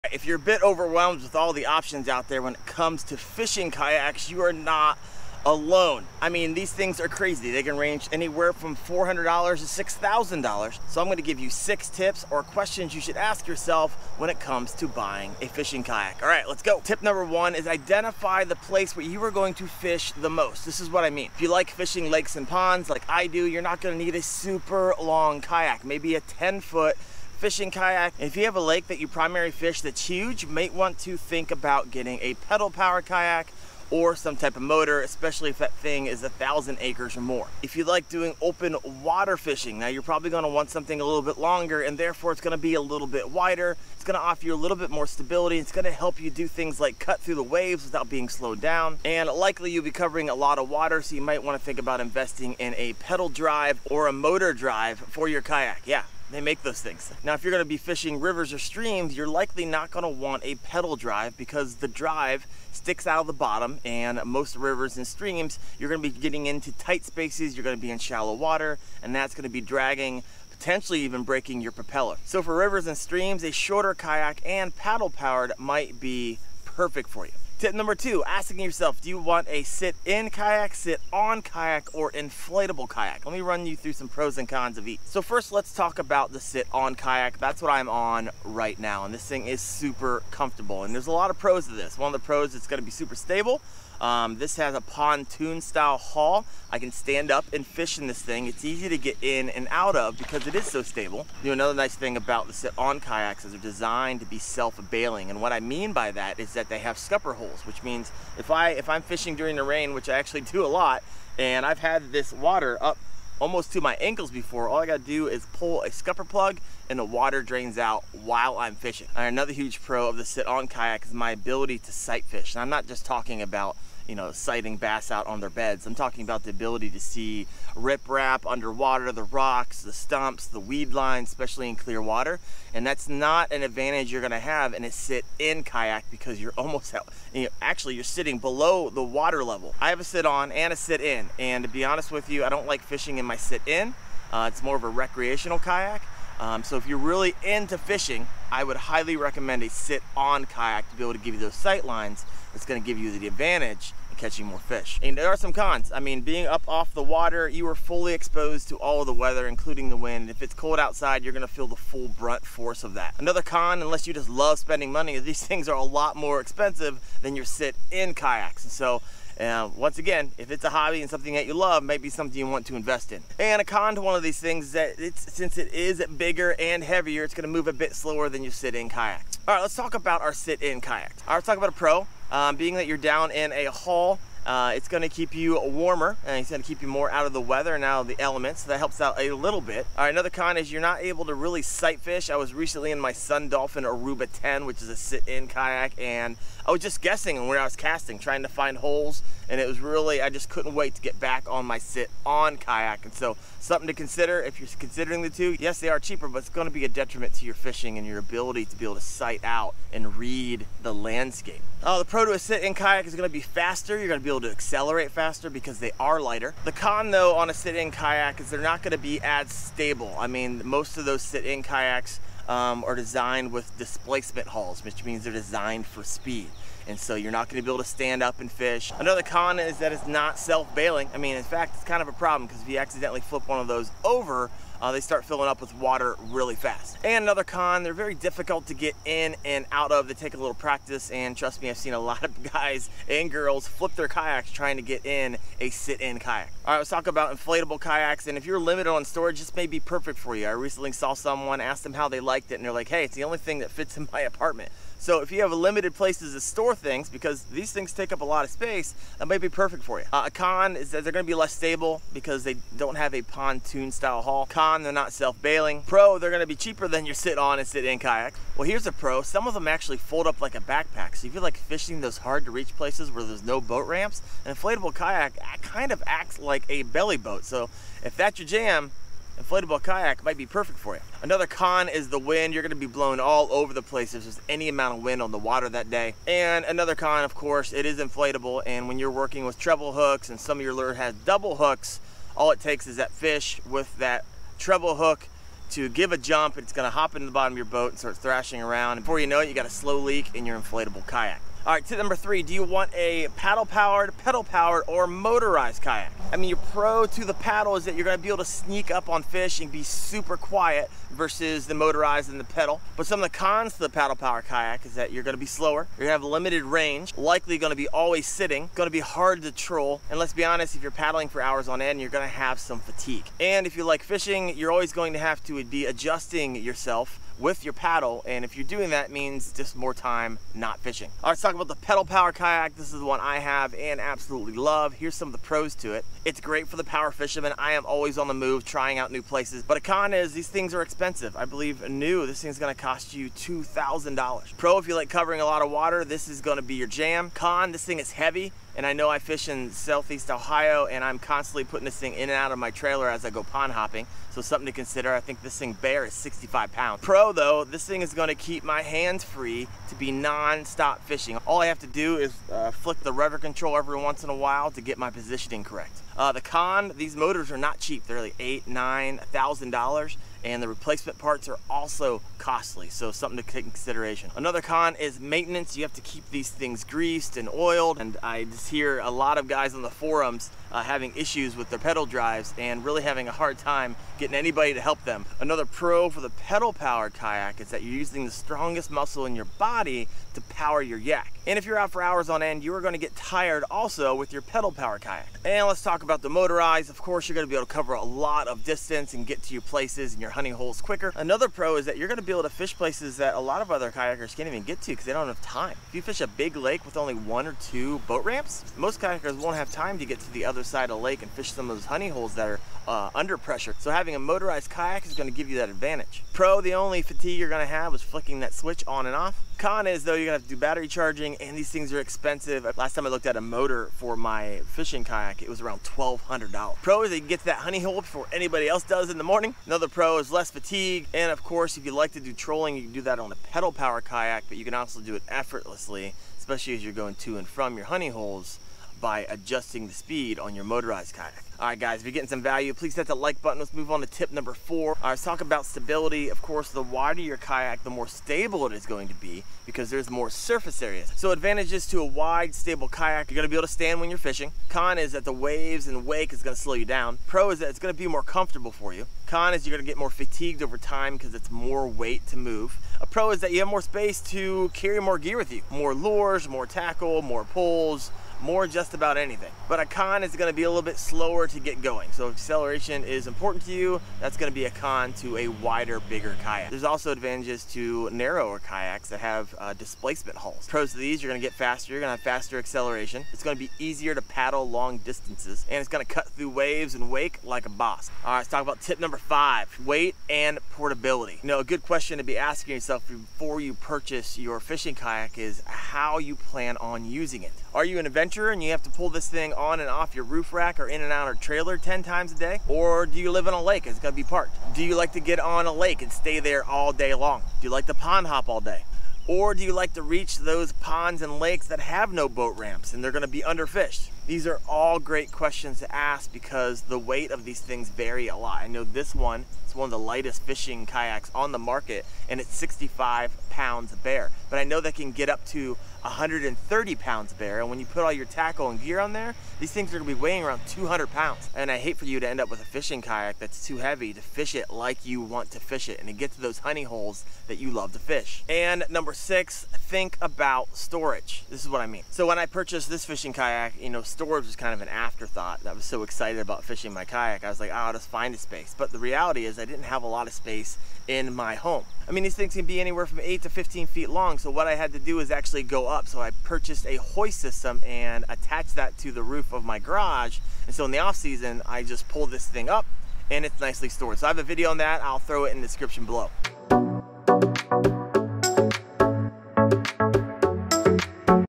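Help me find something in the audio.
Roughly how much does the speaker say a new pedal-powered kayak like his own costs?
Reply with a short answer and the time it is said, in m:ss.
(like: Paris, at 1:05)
$2,000, at 5:43.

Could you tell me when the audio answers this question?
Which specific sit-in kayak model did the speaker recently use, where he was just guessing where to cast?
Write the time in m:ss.
3:13.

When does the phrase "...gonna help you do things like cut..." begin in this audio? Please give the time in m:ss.
0:45.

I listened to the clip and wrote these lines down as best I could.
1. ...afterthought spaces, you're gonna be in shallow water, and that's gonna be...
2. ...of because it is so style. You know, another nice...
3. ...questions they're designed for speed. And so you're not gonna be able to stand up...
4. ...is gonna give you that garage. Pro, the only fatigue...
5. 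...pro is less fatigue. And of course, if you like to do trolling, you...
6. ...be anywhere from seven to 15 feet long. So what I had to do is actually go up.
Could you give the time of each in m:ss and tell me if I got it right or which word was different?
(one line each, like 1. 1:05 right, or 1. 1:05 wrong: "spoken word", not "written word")
1. 1:06 wrong: "tight", not "afterthought"
2. 1:39 wrong: "stable", not "style"
3. 3:45 wrong: "means", not "questions"
4. 6:55 wrong: "advantage", not "garage"
5. 7:09 right
6. 9:12 wrong: "eight", not "seven".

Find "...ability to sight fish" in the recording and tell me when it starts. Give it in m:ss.
2:01.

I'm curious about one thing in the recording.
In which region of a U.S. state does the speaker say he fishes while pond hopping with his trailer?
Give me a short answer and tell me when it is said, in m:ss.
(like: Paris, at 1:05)
Southeast Ohio, at 5:49.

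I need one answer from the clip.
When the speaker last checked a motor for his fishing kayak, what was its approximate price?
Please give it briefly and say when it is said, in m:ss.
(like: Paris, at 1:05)
$1,200, at 7:05.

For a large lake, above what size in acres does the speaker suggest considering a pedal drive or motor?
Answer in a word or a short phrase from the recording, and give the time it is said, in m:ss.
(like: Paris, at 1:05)
1,000 acres, at 0:36.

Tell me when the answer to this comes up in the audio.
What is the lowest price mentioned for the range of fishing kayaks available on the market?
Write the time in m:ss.
0:08.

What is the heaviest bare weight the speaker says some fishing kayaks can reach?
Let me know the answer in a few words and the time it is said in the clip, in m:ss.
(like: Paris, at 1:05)
130 pounds, at 8:46.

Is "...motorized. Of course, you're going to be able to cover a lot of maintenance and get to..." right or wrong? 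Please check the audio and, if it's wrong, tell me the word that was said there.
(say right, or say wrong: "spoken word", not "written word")
wrong: "distance", not "maintenance".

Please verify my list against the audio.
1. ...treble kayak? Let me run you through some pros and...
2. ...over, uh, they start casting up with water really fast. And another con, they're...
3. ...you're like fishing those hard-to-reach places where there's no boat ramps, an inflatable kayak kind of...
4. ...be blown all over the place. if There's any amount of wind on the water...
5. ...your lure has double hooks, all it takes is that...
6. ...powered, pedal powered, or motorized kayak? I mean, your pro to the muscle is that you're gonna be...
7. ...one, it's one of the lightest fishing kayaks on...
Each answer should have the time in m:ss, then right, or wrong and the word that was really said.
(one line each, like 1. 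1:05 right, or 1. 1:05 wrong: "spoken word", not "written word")
1. 1:22 wrong: "inflatable", not "treble"
2. 3:54 wrong: "filling", not "casting"
3. 4:31 right
4. 4:42 right
5. 4:50 right
6. 5:03 wrong: "paddle", not "muscle"
7. 8:39 right.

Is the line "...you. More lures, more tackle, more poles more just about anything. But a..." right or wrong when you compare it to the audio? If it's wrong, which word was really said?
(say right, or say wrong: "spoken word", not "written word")
right.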